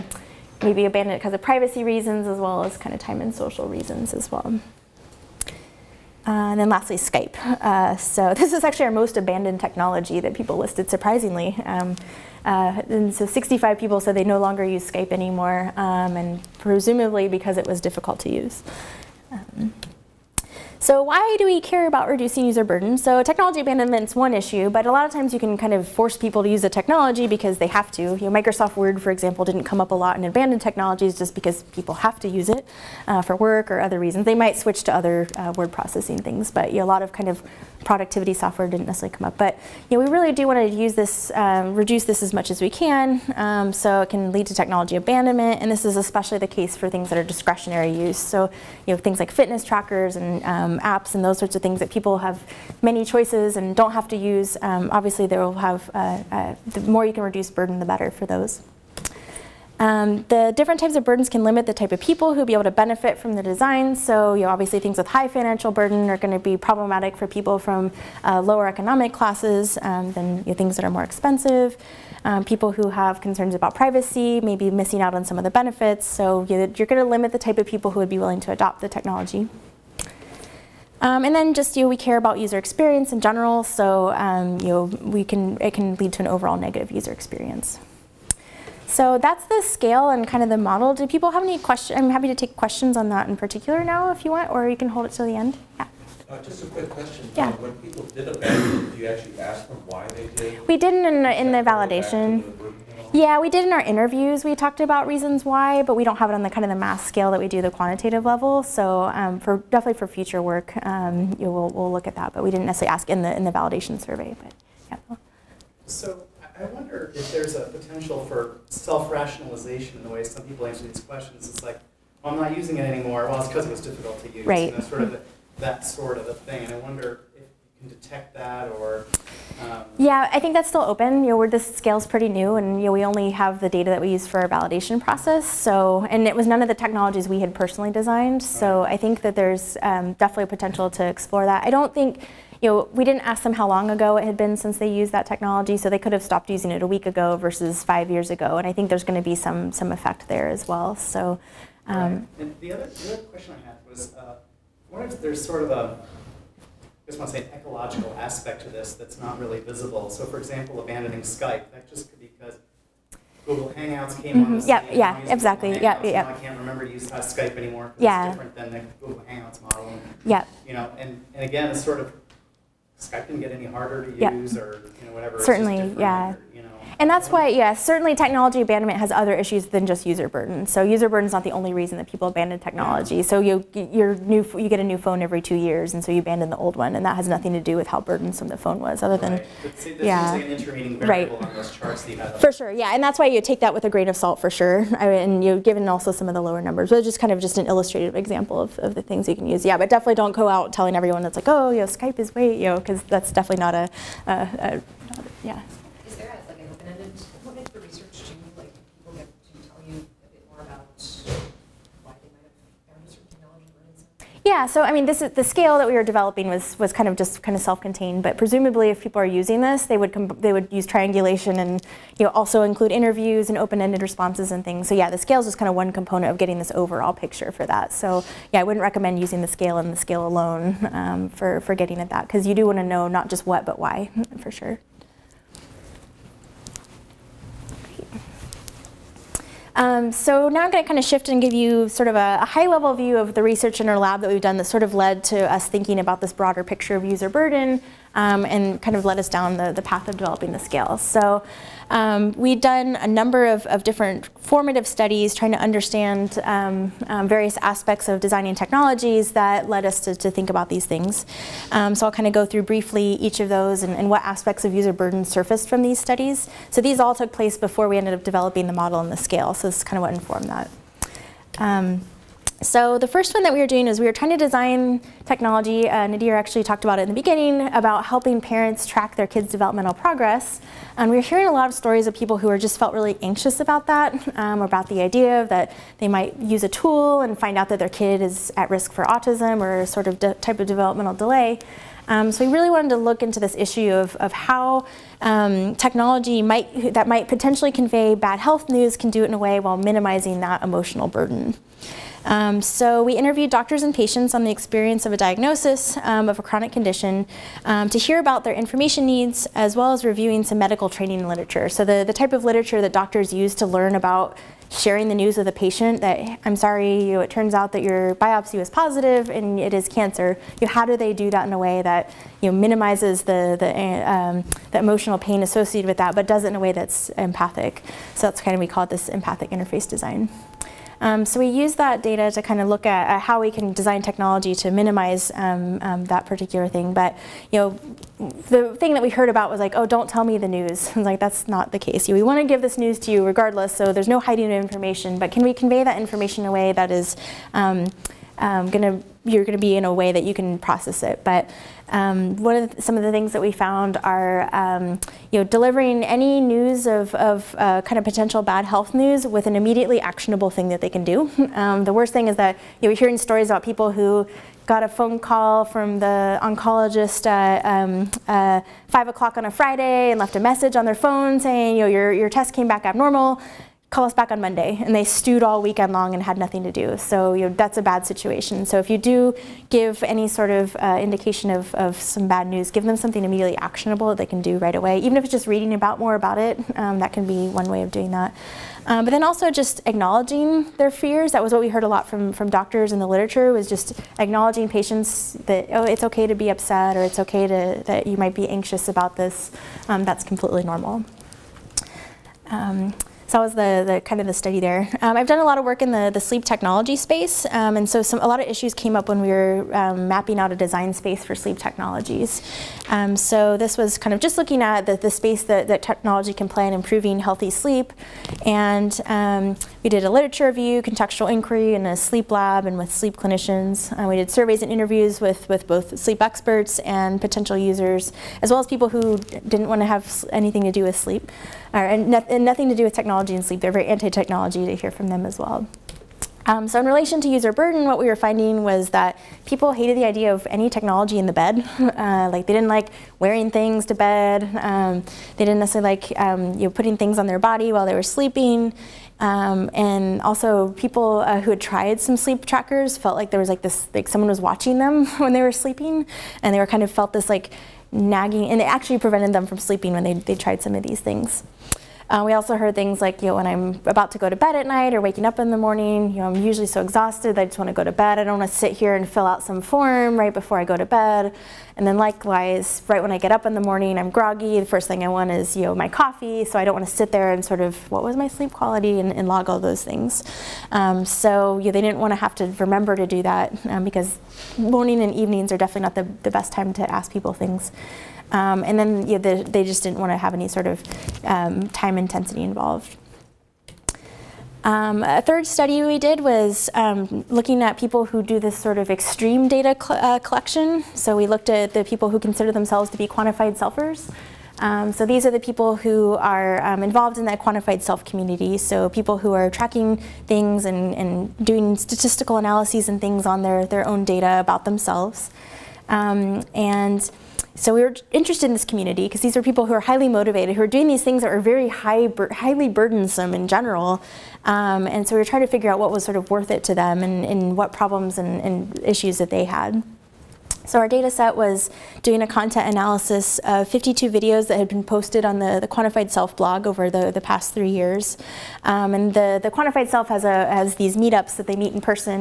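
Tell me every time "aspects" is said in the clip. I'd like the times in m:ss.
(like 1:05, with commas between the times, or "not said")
2:38, 4:17, 4:24.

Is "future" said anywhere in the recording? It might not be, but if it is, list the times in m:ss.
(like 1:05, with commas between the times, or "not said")
1:50.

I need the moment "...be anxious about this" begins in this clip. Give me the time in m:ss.
6:38.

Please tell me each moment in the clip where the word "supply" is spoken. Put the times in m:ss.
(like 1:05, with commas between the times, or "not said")
not said.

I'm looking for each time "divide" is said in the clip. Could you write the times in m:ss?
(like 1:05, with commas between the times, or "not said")
not said.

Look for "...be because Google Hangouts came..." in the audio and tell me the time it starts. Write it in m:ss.
2:42.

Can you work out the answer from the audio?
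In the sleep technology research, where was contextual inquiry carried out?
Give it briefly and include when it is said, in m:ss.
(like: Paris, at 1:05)
A sleep lab, at 7:01.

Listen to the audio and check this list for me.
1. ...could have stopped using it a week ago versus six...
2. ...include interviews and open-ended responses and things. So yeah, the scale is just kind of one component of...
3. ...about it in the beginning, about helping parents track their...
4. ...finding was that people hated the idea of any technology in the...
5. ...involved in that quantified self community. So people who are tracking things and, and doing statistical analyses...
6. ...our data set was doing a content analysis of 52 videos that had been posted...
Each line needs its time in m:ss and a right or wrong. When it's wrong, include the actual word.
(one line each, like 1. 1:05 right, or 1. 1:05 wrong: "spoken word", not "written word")
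1. 2:25 wrong: "five", not "six"
2. 3:42 right
3. 4:36 right
4. 7:18 right
5. 8:26 right
6. 8:50 right.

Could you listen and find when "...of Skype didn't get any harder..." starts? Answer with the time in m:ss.
2:51.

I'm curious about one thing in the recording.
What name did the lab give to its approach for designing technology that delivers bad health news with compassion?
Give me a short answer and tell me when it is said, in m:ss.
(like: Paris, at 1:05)
Empathic interface design, at 5:29.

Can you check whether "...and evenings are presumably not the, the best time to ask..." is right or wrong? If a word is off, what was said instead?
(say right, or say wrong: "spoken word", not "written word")
wrong: "definitely", not "presumably".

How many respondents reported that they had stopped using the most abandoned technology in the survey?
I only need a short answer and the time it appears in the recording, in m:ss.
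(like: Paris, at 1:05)
65, at 0:13.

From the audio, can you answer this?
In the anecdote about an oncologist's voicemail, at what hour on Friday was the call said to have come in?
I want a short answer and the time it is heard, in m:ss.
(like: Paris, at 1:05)
5 o'clock, at 6:08.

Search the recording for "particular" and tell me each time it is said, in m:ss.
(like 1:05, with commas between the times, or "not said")
1:33, 5:36.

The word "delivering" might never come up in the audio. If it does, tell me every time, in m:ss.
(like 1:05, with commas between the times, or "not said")
5:55.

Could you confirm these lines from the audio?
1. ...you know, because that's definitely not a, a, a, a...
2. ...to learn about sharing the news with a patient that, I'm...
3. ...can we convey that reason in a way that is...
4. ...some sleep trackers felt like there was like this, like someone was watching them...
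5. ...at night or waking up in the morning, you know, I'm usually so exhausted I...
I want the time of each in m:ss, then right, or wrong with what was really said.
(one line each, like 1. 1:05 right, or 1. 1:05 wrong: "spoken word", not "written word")
1. 3:22 right
2. 5:13 right
3. 5:45 wrong: "information", not "reason"
4. 7:31 right
5. 7:44 right.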